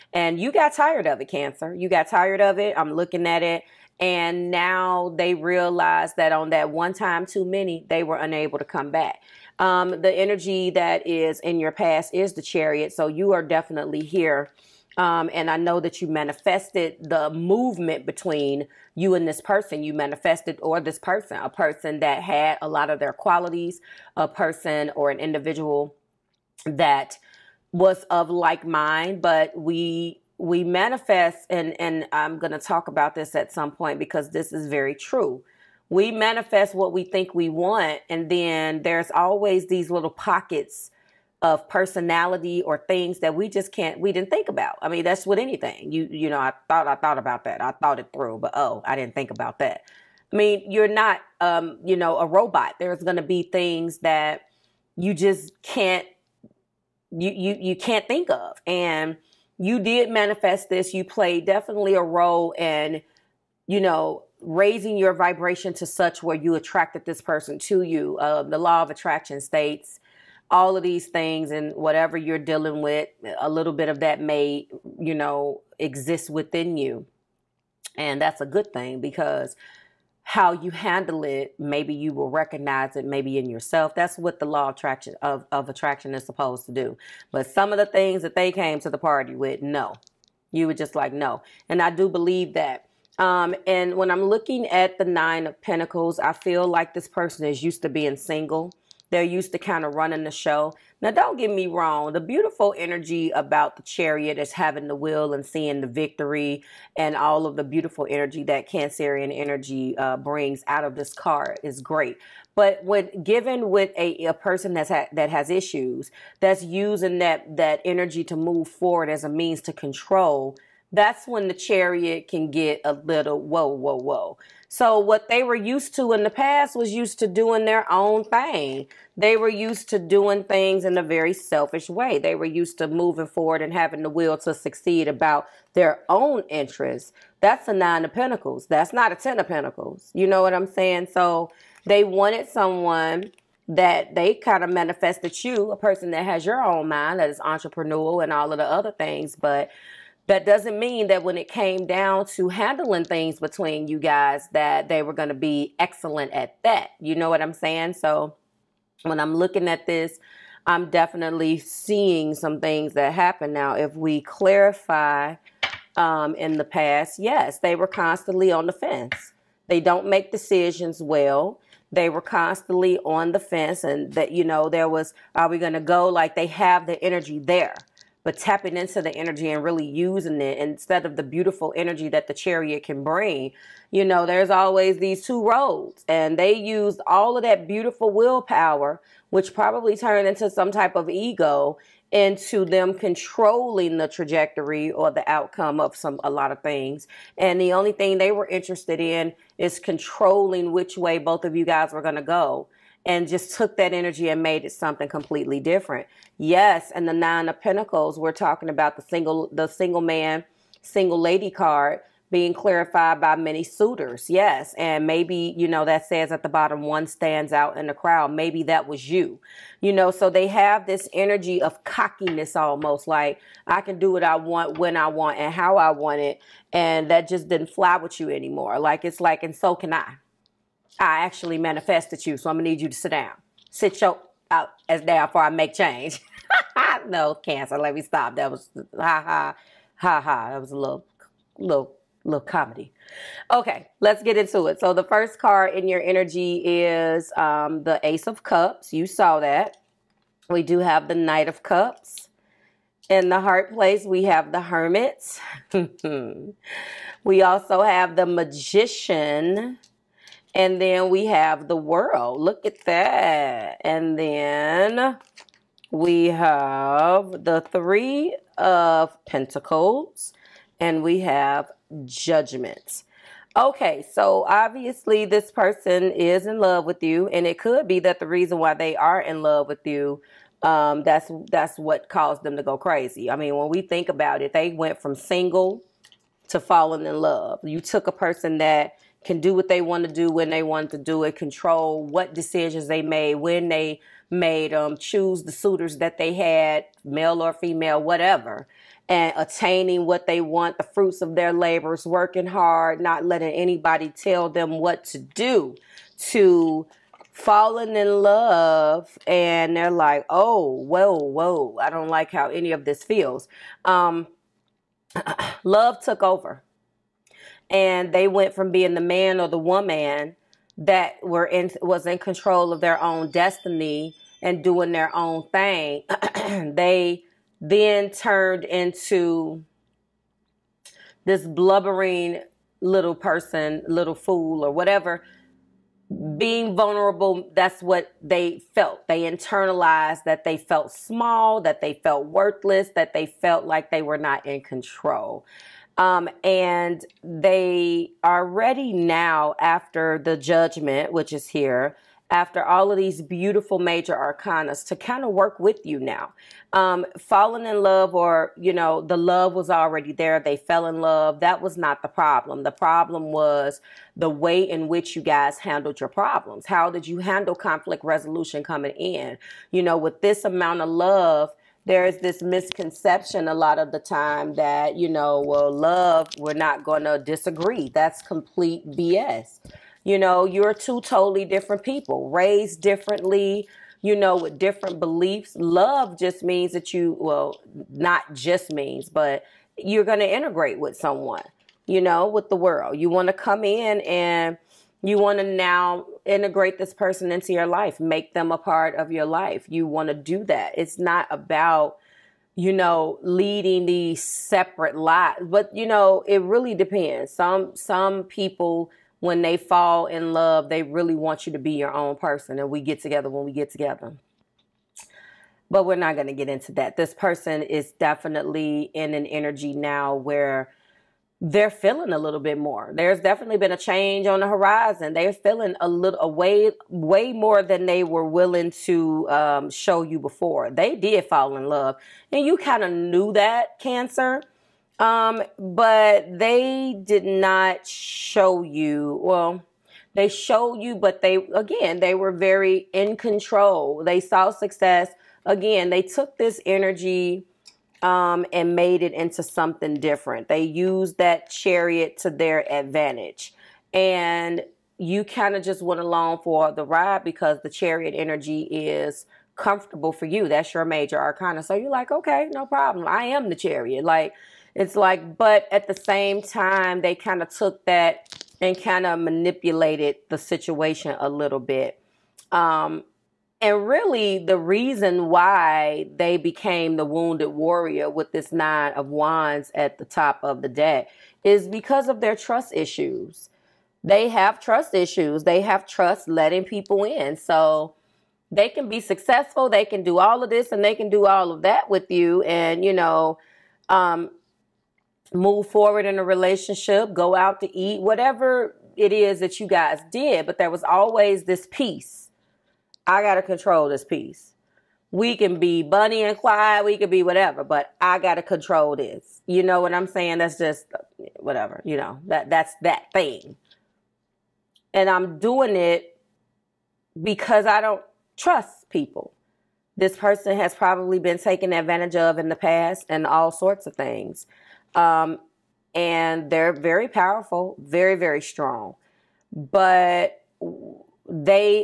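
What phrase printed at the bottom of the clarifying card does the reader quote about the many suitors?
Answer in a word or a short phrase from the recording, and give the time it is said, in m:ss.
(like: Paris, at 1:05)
One stands out in the crowd, at 3:36.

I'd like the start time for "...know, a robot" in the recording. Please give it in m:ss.
0:51.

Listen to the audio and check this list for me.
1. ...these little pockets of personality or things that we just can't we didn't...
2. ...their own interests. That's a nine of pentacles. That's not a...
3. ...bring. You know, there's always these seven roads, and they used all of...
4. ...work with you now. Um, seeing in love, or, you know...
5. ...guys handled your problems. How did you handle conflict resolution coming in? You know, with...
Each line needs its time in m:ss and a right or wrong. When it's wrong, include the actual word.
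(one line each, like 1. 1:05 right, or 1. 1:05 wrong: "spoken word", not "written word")
1. 0:39 right
2. 2:15 right
3. 3:03 wrong: "two", not "seven"
4. 5:55 wrong: "falling", not "seeing"
5. 6:05 right.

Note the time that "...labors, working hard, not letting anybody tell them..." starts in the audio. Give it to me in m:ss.
5:01.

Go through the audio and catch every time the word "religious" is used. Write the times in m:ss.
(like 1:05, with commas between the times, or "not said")
not said.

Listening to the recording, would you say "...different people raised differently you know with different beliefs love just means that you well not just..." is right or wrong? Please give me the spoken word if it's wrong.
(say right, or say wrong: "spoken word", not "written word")
right.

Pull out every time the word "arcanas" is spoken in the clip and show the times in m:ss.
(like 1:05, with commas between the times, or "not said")
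5:54, 7:41.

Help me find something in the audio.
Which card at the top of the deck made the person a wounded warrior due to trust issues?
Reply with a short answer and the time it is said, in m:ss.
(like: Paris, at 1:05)
Nine of wands, at 7:58.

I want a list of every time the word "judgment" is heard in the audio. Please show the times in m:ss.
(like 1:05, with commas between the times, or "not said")
4:32, 5:50.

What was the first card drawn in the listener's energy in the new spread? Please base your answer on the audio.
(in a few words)
Ace of Cups.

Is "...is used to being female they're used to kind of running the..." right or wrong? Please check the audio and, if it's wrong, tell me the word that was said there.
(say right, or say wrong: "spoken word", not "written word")
wrong: "single", not "female".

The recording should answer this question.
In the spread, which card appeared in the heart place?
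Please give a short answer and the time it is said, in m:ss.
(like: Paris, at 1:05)
The Hermit, at 4:14.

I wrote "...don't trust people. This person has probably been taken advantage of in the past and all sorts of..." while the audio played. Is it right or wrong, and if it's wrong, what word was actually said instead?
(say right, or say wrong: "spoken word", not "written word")
right.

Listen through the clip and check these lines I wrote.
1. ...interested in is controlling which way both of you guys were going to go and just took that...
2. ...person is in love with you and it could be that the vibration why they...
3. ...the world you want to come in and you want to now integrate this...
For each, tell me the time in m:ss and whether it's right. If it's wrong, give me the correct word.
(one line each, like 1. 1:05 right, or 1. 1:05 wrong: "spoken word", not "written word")
1. 3:18 right
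2. 4:35 wrong: "reason", not "vibration"
3. 6:32 right.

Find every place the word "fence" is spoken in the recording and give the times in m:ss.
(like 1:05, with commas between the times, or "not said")
2:48, 2:53.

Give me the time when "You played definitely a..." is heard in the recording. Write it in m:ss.
1:00.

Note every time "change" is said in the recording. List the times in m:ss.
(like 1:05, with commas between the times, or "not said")
3:55, 7:03.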